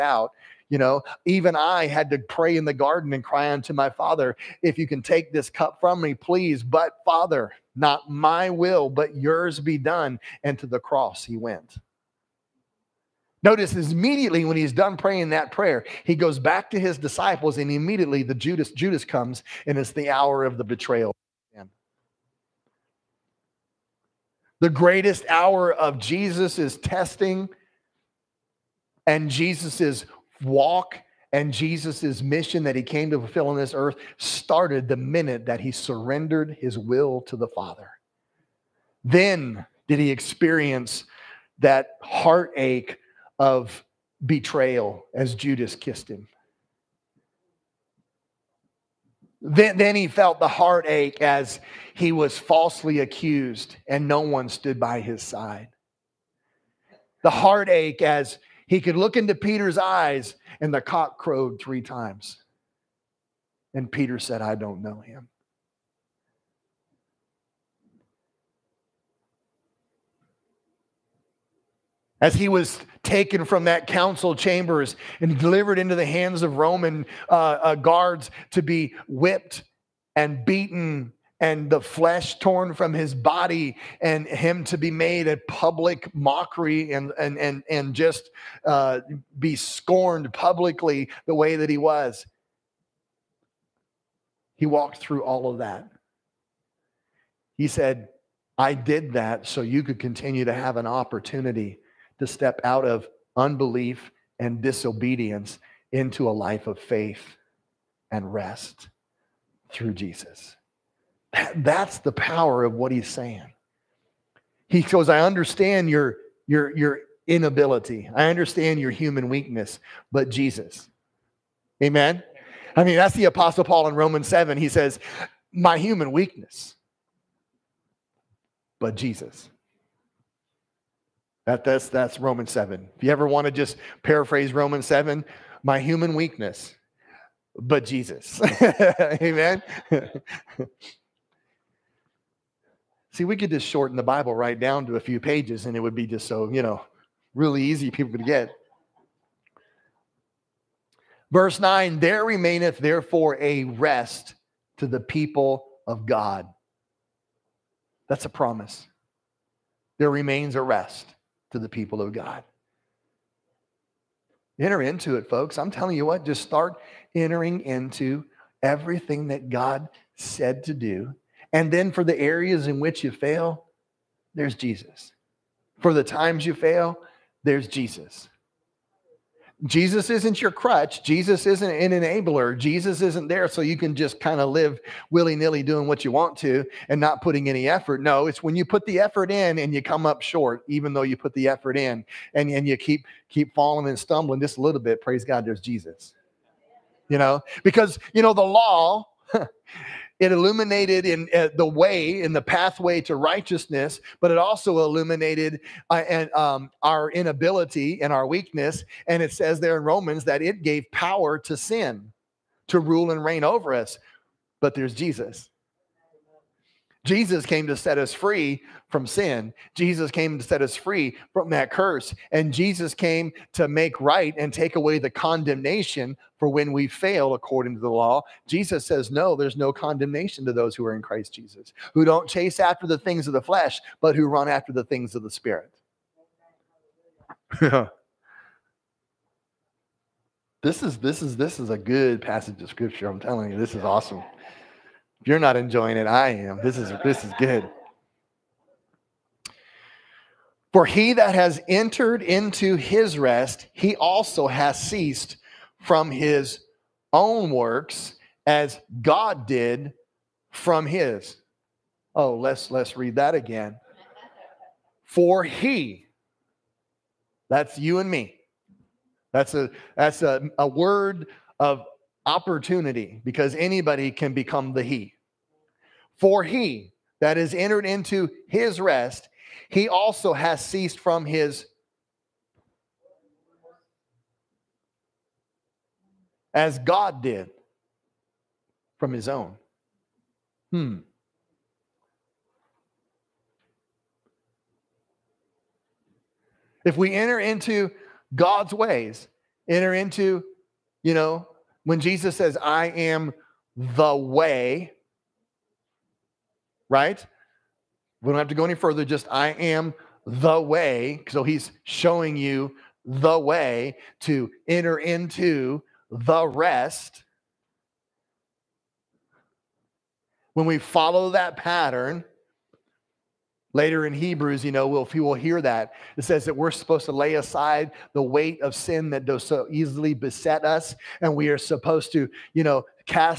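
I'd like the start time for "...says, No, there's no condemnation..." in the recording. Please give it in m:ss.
3:48.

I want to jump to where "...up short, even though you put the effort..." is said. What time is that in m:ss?
3:10.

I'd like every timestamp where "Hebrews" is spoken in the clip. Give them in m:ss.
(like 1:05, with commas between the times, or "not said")
5:24.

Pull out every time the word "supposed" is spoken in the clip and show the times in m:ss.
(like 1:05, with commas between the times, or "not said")
5:26, 5:31.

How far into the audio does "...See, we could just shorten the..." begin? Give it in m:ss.
2:23.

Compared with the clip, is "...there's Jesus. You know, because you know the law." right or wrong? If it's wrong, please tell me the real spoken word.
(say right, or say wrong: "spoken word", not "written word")
right.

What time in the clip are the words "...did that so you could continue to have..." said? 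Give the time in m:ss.
1:38.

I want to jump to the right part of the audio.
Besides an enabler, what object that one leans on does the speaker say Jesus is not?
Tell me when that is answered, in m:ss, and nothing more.
3:00.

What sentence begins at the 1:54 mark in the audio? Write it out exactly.
He goes, I understand your, your, your inability.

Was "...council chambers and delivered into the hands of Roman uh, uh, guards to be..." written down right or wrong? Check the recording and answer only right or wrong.
right.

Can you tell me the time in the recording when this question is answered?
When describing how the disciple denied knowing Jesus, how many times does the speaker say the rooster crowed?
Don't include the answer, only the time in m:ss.
1:01.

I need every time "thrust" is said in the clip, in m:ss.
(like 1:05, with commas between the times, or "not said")
not said.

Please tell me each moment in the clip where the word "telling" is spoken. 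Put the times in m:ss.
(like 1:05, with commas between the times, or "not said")
2:45, 4:03.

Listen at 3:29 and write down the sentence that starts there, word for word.
And it says there in Romans that it gave power to sin to rule and reign over us.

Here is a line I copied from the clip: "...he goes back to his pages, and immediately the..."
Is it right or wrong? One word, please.
wrong.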